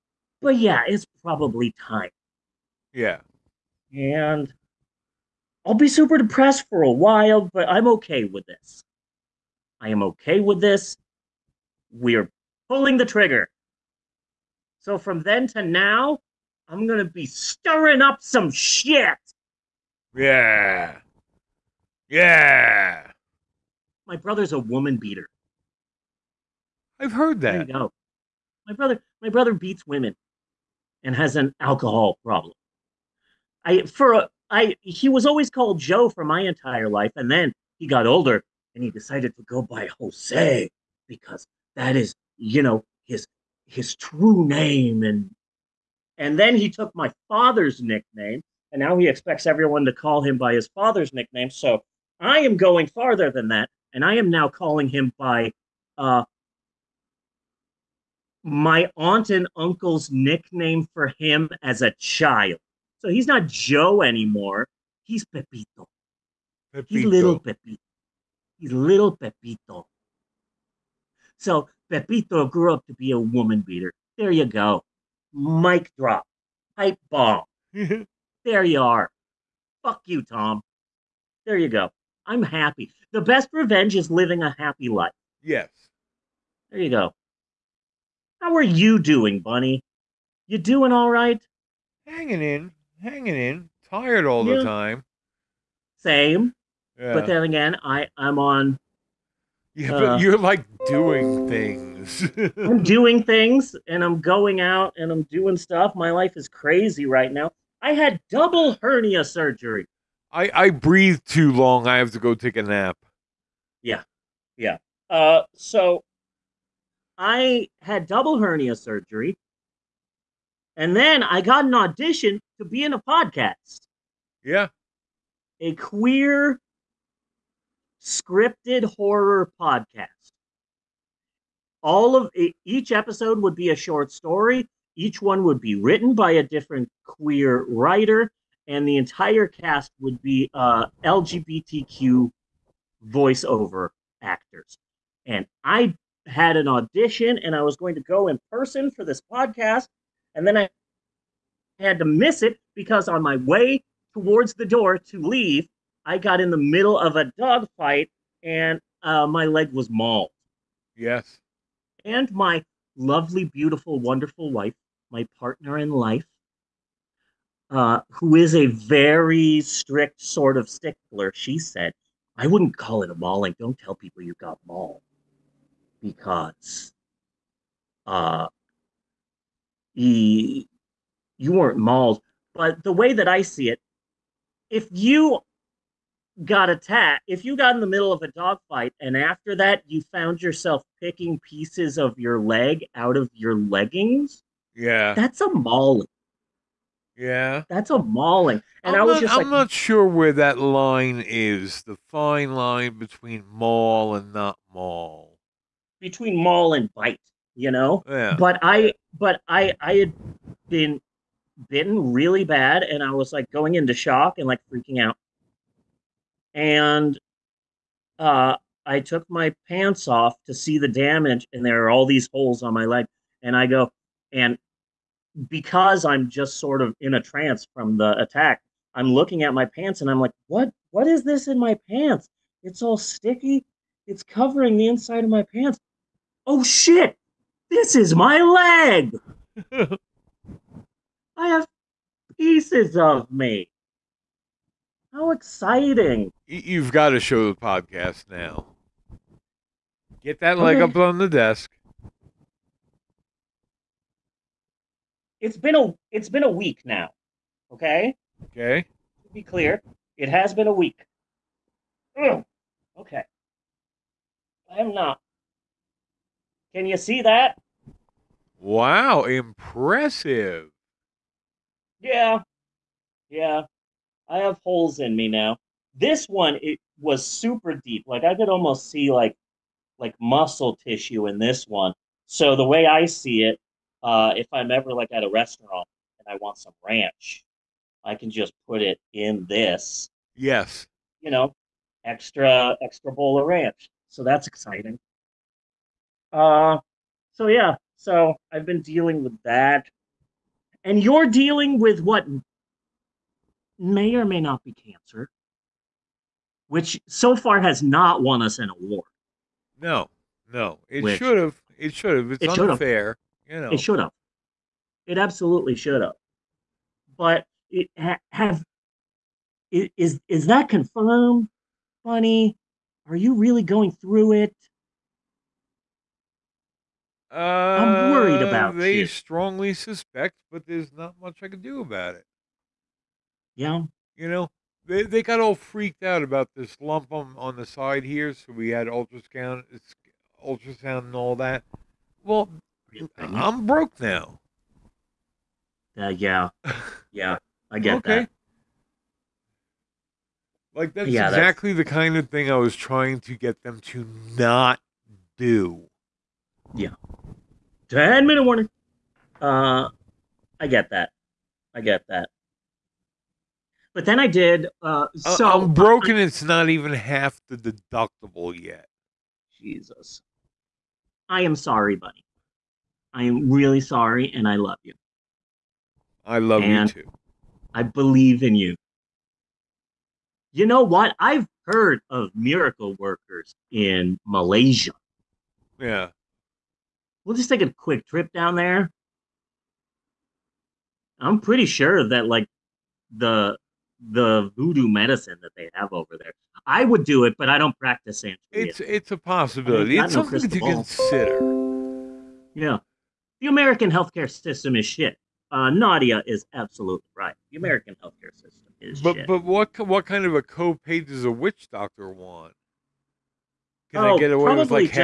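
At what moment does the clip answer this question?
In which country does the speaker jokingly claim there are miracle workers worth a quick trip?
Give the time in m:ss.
6:24.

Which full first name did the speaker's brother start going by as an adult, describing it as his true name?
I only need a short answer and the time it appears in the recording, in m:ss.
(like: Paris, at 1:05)
Jose, at 0:39.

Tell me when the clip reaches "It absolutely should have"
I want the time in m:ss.
5:15.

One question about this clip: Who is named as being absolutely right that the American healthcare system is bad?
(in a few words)
Nadia.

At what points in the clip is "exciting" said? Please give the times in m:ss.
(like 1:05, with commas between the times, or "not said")
4:05, 4:54.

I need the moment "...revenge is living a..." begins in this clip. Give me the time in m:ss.
1:23.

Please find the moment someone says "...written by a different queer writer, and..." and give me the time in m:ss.
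2:15.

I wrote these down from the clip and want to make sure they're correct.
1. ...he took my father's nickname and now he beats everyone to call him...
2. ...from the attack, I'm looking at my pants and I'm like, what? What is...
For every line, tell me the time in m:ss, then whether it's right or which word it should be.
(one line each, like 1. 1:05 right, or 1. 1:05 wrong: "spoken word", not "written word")
1. 0:46 wrong: "expects", not "beats"
2. 3:47 right.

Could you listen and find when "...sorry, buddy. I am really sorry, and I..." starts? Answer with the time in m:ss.
6:11.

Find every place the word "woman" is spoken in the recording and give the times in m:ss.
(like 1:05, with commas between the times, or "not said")
0:24, 1:13.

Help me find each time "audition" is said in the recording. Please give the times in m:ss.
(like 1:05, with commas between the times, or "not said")
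2:01, 2:26.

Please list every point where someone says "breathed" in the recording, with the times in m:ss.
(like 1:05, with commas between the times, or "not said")
1:50.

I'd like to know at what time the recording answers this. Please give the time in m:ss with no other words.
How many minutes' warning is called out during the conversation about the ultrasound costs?
5:57.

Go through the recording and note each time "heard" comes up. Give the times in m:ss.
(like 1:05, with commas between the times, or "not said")
0:27, 6:21.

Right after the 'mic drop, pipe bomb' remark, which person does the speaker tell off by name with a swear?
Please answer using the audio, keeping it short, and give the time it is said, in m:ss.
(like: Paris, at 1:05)
Tom, at 1:20.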